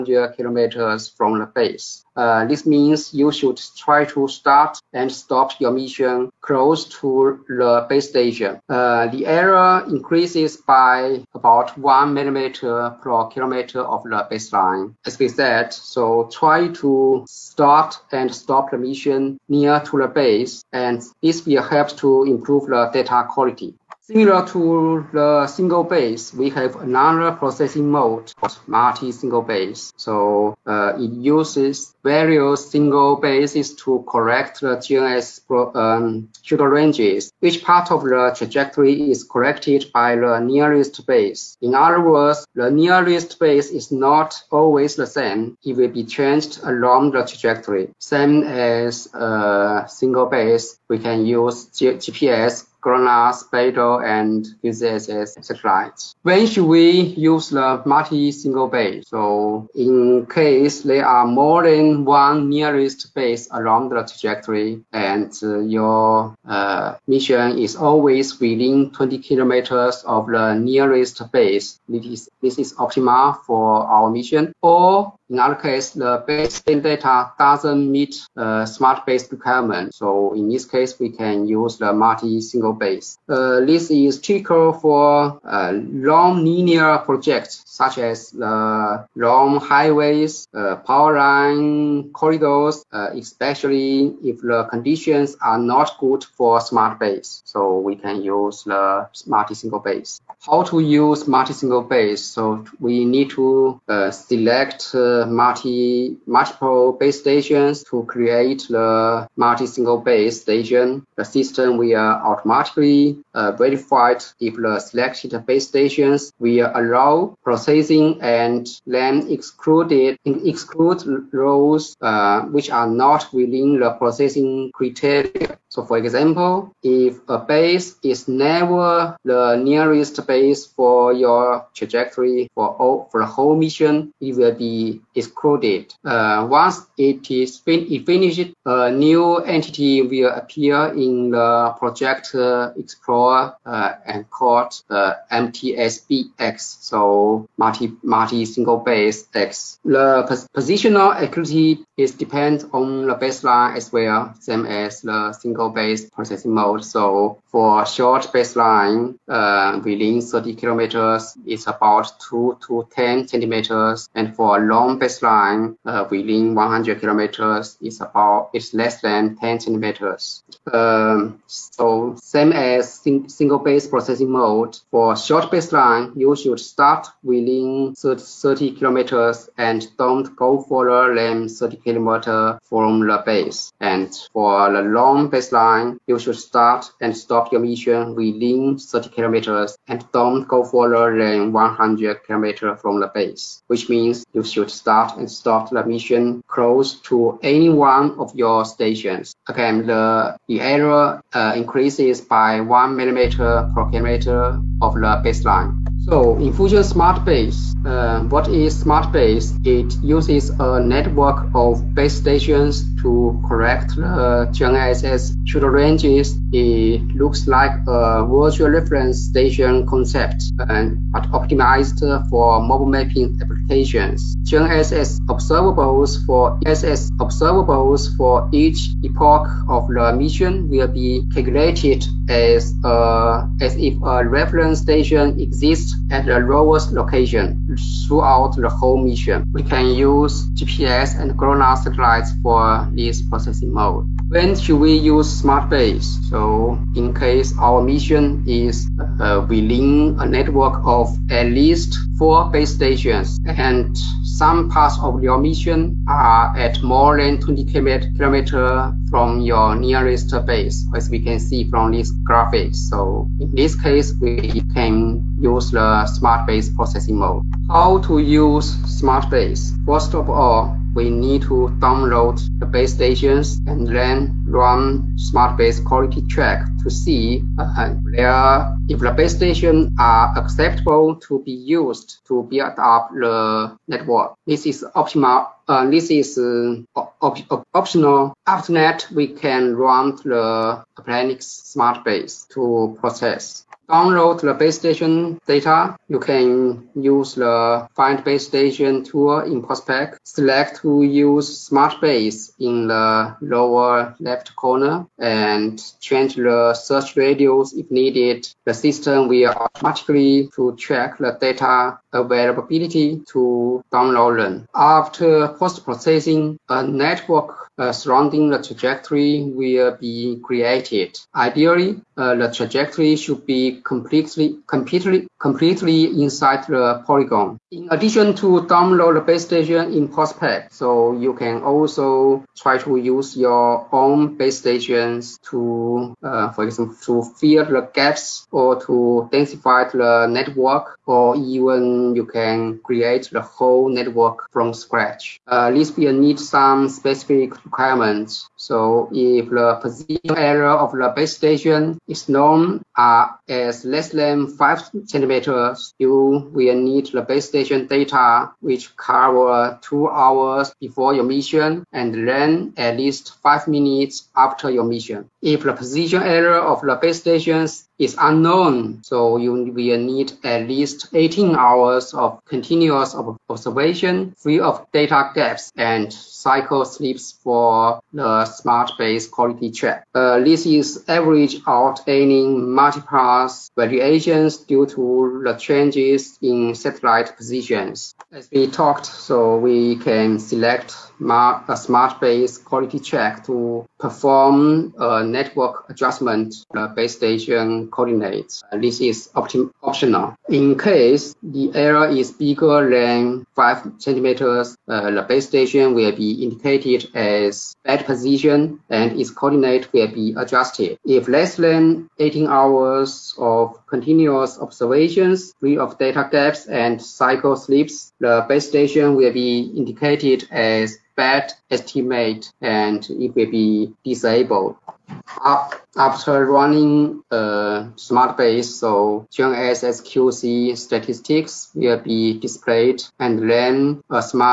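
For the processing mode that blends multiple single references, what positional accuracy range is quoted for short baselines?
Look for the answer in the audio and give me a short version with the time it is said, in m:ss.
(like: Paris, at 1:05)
2 to 10 centimeters, at 2:42.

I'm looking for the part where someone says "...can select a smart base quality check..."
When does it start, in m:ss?
6:29.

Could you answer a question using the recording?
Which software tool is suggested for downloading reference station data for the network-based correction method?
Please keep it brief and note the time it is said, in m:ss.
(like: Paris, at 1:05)
find base station tool, at 4:57.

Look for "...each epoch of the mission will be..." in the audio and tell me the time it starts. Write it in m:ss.
3:48.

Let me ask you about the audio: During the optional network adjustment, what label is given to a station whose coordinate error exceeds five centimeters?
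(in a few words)
bad position.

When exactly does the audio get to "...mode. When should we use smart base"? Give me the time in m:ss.
4:03.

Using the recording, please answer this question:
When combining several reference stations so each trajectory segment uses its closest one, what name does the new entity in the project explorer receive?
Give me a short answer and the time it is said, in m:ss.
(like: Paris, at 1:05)
MTSBX, at 2:25.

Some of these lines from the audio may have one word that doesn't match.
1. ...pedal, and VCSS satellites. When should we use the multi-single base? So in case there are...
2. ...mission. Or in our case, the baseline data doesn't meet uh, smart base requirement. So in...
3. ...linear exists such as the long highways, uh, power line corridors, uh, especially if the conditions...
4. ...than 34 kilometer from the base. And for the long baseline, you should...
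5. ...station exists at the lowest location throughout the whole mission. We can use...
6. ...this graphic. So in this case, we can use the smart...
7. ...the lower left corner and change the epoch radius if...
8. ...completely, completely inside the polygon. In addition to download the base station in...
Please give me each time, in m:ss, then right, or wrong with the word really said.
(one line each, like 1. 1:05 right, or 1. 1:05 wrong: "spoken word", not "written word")
1. 0:53 right
2. 1:14 right
3. 1:26 wrong: "projects", not "exists"
4. 3:01 wrong: "30", not "34"
5. 3:54 right
6. 4:21 right
7. 5:02 wrong: "search", not "epoch"
8. 5:24 right.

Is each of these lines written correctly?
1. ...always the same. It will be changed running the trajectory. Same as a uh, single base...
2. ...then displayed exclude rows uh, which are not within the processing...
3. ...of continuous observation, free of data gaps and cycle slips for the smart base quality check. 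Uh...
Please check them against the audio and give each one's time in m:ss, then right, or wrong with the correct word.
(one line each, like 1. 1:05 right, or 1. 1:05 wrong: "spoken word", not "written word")
1. 0:44 wrong: "along", not "running"
2. 1:58 wrong: "excluded", not "displayed"
3. 6:12 right.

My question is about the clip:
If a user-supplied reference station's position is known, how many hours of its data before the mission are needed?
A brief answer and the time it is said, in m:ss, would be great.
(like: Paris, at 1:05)
2 hours, at 5:59.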